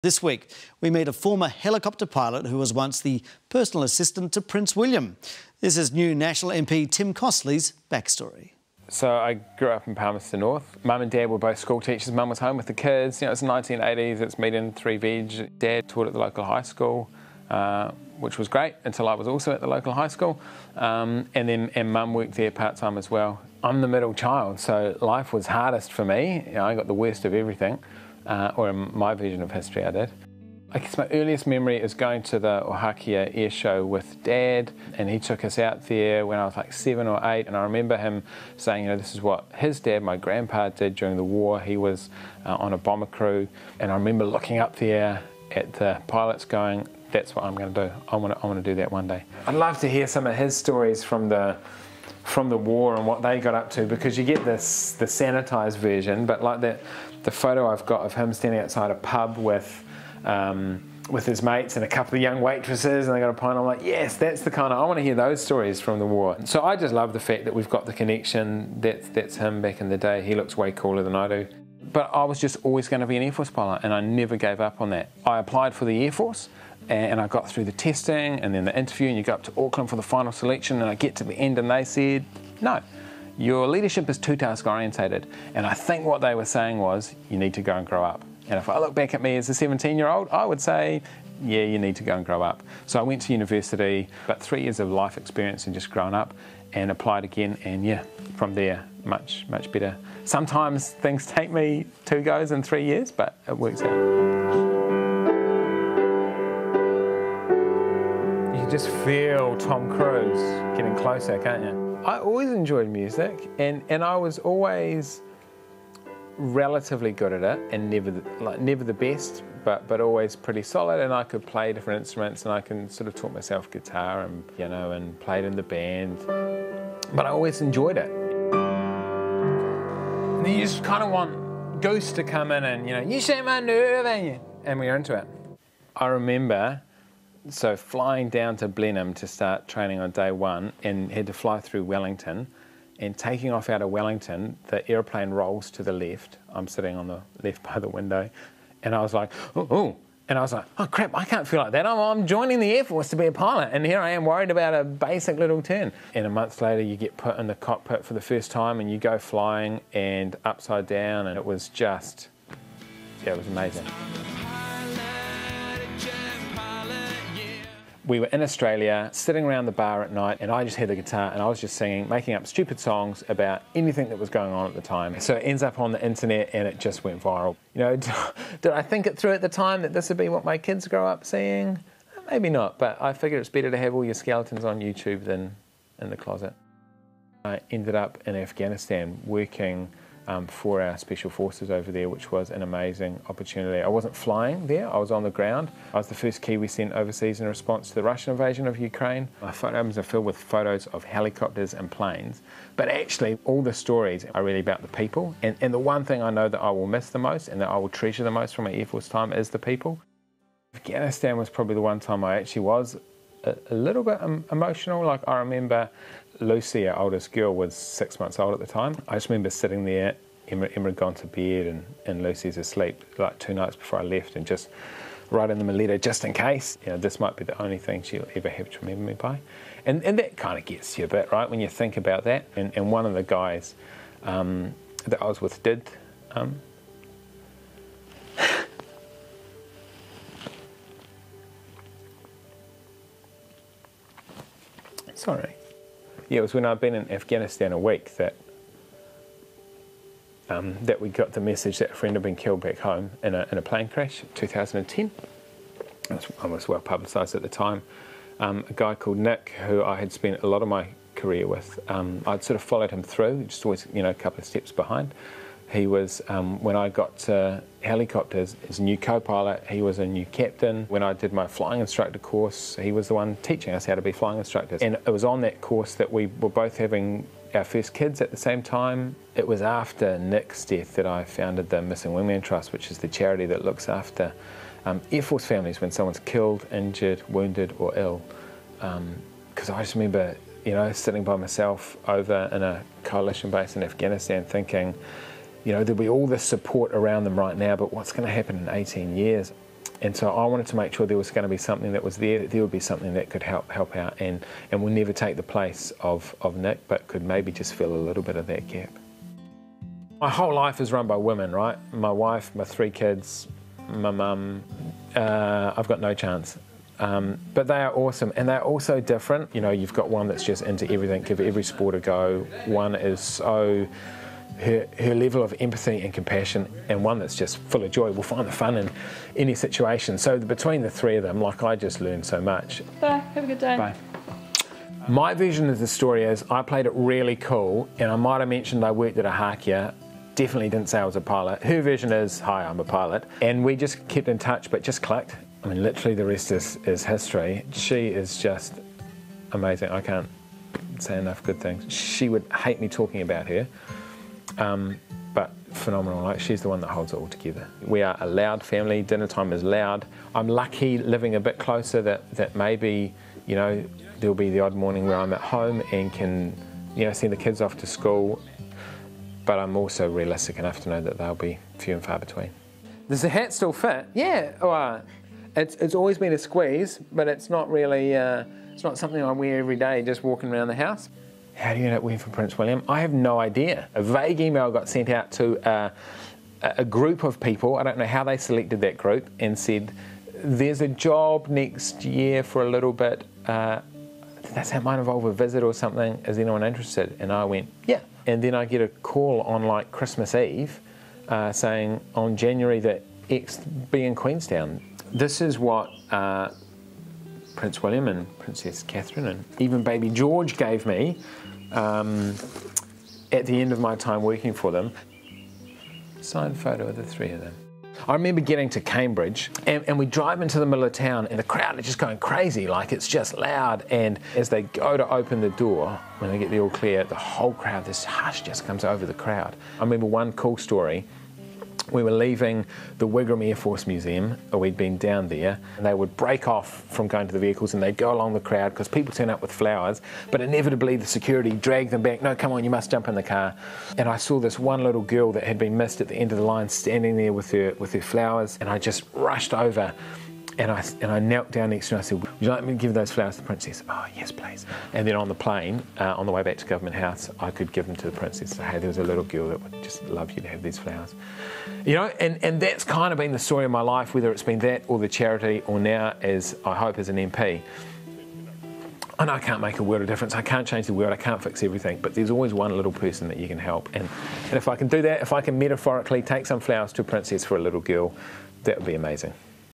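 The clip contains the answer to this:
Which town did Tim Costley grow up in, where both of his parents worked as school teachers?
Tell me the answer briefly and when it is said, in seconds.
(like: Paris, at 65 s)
Palmerston North, at 9 s.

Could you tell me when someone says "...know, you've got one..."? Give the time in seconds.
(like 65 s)
319 s.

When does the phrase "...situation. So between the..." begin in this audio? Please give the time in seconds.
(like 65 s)
329 s.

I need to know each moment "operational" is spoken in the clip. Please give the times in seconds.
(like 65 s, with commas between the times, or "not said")
not said.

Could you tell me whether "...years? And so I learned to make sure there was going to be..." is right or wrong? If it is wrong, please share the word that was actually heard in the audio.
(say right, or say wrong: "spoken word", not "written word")
wrong: "wanted", not "learned".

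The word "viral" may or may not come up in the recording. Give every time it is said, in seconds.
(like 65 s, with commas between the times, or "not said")
177 s.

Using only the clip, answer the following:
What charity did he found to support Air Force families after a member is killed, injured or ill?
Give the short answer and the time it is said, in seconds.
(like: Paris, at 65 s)
Missing Man Trust, at 281 s.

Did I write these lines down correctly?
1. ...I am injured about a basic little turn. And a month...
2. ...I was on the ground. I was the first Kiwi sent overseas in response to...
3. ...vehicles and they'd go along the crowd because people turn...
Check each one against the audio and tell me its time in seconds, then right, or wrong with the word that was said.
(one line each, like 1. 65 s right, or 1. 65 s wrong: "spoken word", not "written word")
1. 153 s wrong: "worried", not "injured"
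2. 194 s right
3. 437 s right.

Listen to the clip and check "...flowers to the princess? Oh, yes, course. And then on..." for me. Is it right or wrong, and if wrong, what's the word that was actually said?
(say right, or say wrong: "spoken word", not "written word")
wrong: "please", not "course".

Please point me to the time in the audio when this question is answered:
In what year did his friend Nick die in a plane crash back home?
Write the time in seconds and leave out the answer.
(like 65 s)
254 s.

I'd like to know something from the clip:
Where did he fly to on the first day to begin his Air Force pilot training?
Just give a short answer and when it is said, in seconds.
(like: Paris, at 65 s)
Blenheim, at 138 s.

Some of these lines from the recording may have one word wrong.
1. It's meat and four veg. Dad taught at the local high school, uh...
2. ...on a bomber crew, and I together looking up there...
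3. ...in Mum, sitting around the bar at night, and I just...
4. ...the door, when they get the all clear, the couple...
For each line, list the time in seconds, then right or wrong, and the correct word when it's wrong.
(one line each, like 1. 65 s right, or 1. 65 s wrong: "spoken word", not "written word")
1. 14 s wrong: "three", not "four"
2. 42 s wrong: "remember", not "together"
3. 168 s wrong: "Australia", not "Mum"
4. 425 s wrong: "whole", not "couple".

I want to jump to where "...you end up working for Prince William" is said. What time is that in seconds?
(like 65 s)
381 s.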